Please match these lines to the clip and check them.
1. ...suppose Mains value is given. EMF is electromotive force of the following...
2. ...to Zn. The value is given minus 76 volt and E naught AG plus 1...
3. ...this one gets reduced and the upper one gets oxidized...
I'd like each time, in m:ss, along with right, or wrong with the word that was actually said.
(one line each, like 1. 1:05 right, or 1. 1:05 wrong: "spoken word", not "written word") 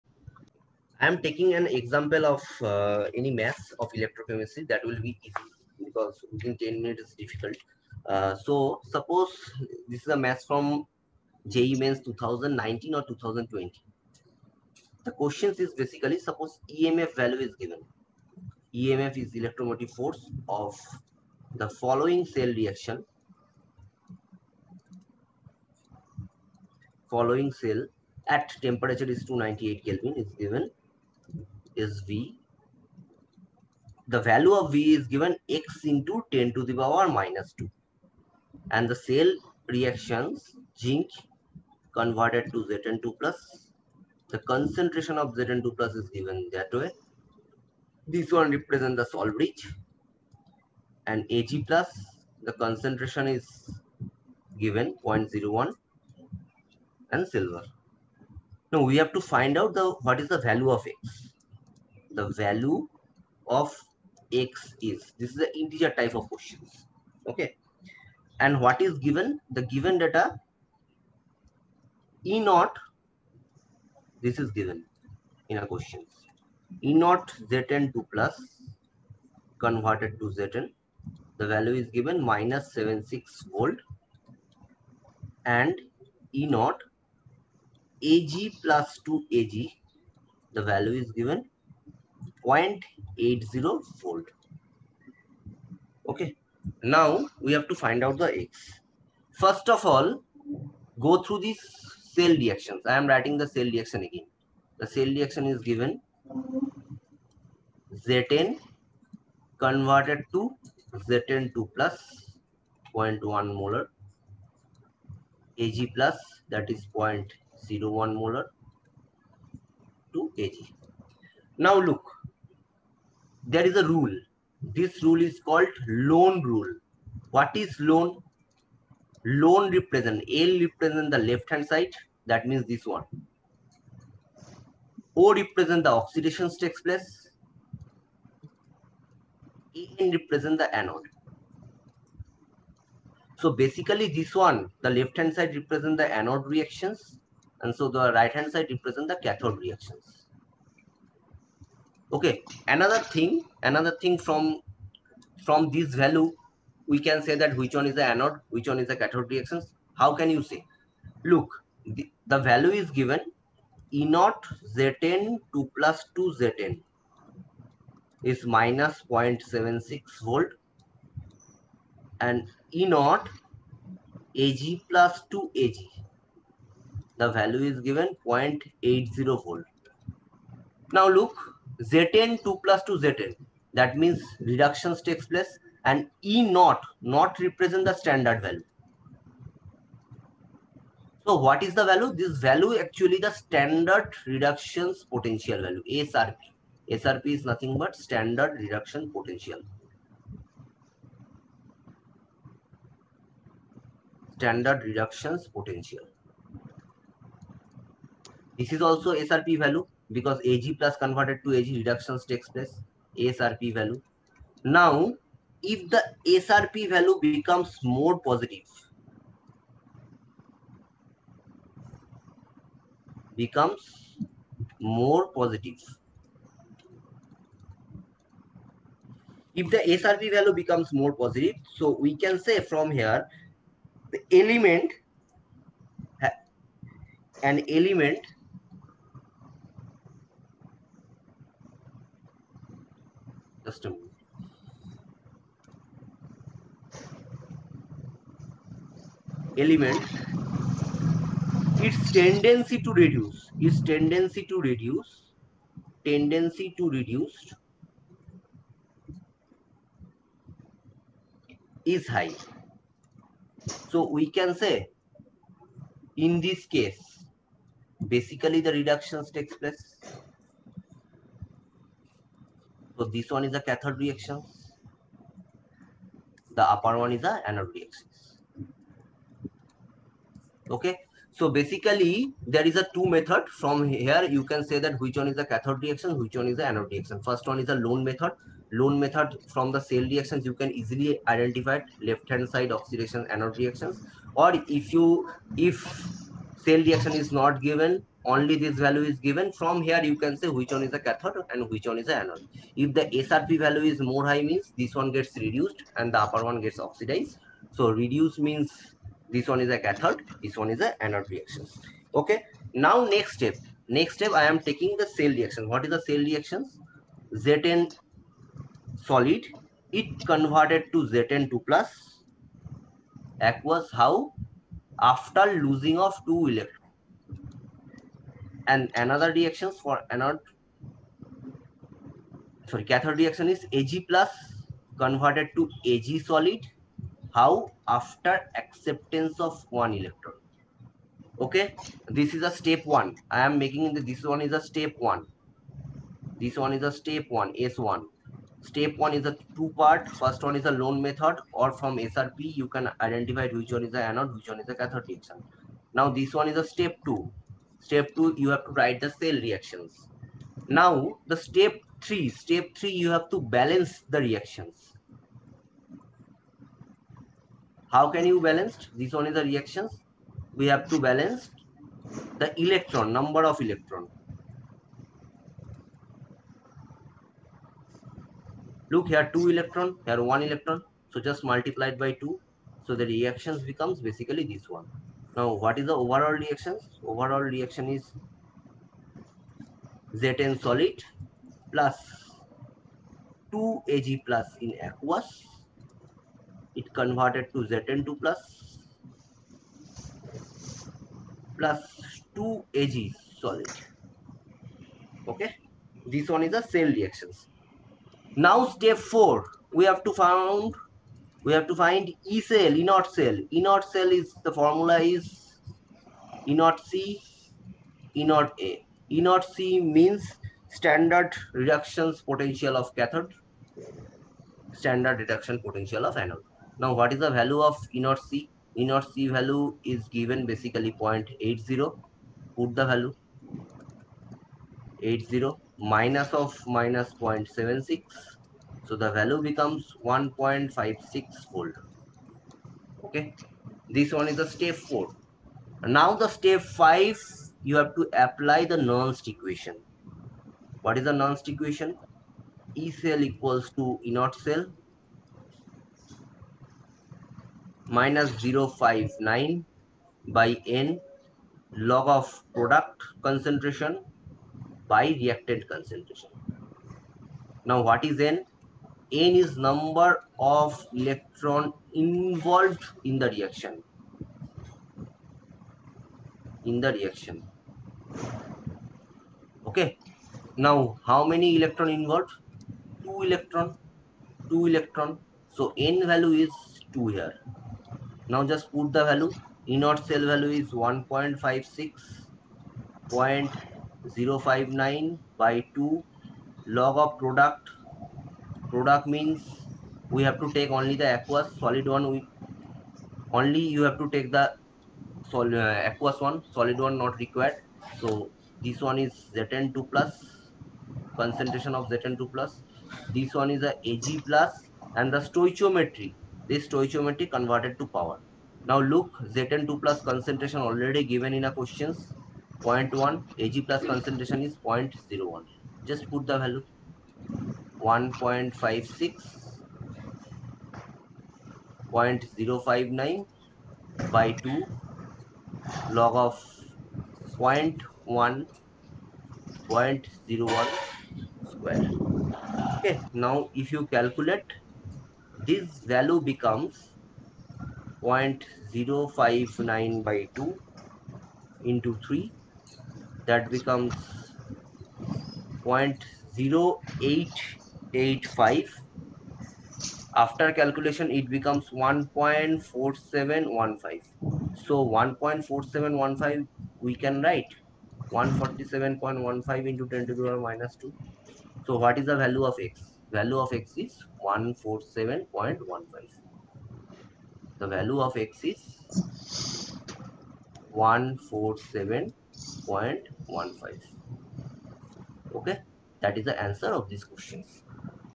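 1. 0:16 wrong: "EMF", not "Mains"
2. 1:20 wrong: "2", not "1"
3. 5:04 right.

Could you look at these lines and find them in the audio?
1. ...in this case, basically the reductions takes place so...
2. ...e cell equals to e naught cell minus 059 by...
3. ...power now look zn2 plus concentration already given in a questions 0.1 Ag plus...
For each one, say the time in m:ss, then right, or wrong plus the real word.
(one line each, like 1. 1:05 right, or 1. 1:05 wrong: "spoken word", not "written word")
1. 4:26 right
2. 7:32 right
3. 8:37 right.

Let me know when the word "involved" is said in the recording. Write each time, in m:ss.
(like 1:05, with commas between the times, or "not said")
7:51, 8:01.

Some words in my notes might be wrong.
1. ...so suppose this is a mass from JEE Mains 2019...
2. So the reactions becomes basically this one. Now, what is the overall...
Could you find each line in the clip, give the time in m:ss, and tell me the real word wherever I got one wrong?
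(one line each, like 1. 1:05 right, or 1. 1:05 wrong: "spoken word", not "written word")
1. 0:08 right
2. 6:22 right.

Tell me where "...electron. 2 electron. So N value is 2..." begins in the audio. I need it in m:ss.
8:03.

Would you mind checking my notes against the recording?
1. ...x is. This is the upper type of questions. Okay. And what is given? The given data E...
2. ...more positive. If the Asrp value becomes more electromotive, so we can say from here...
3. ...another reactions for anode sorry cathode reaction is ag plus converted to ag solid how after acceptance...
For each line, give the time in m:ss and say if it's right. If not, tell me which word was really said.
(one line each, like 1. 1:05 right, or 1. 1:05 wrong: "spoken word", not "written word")
1. 1:04 wrong: "integer", not "upper"
2. 3:44 wrong: "positive", not "electromotive"
3. 5:29 right.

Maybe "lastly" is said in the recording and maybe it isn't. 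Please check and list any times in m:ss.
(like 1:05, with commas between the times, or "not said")
not said.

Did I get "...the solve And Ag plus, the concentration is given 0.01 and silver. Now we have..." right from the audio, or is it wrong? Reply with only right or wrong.
right.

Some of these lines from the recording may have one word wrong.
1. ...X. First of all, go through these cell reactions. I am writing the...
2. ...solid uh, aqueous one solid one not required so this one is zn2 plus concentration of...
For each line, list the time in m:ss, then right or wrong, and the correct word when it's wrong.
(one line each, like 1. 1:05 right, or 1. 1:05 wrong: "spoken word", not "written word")
1. 1:38 right
2. 8:25 right.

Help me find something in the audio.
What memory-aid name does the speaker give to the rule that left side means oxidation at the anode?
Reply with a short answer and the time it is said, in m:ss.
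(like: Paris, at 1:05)
LOAN rule, at 2:05.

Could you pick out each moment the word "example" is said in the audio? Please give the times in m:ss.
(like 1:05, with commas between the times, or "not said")
0:01.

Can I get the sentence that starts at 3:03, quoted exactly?
That means reductions takes place and E naught, not represent the standard value.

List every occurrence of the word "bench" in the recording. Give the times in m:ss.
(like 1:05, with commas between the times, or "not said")
not said.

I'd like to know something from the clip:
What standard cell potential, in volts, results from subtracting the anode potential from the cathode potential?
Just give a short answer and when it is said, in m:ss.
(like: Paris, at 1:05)
1.56 volt, at 7:20.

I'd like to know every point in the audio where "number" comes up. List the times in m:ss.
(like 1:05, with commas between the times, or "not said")
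6:13, 7:49.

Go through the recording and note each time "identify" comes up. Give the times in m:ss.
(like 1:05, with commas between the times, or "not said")
4:51, 5:53.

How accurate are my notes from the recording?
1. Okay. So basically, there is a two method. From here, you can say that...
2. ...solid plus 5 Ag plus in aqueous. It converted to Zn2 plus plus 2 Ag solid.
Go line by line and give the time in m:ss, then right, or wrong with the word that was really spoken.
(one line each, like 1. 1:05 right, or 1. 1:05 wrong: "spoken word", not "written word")
1. 4:40 right
2. 6:30 wrong: "2", not "5".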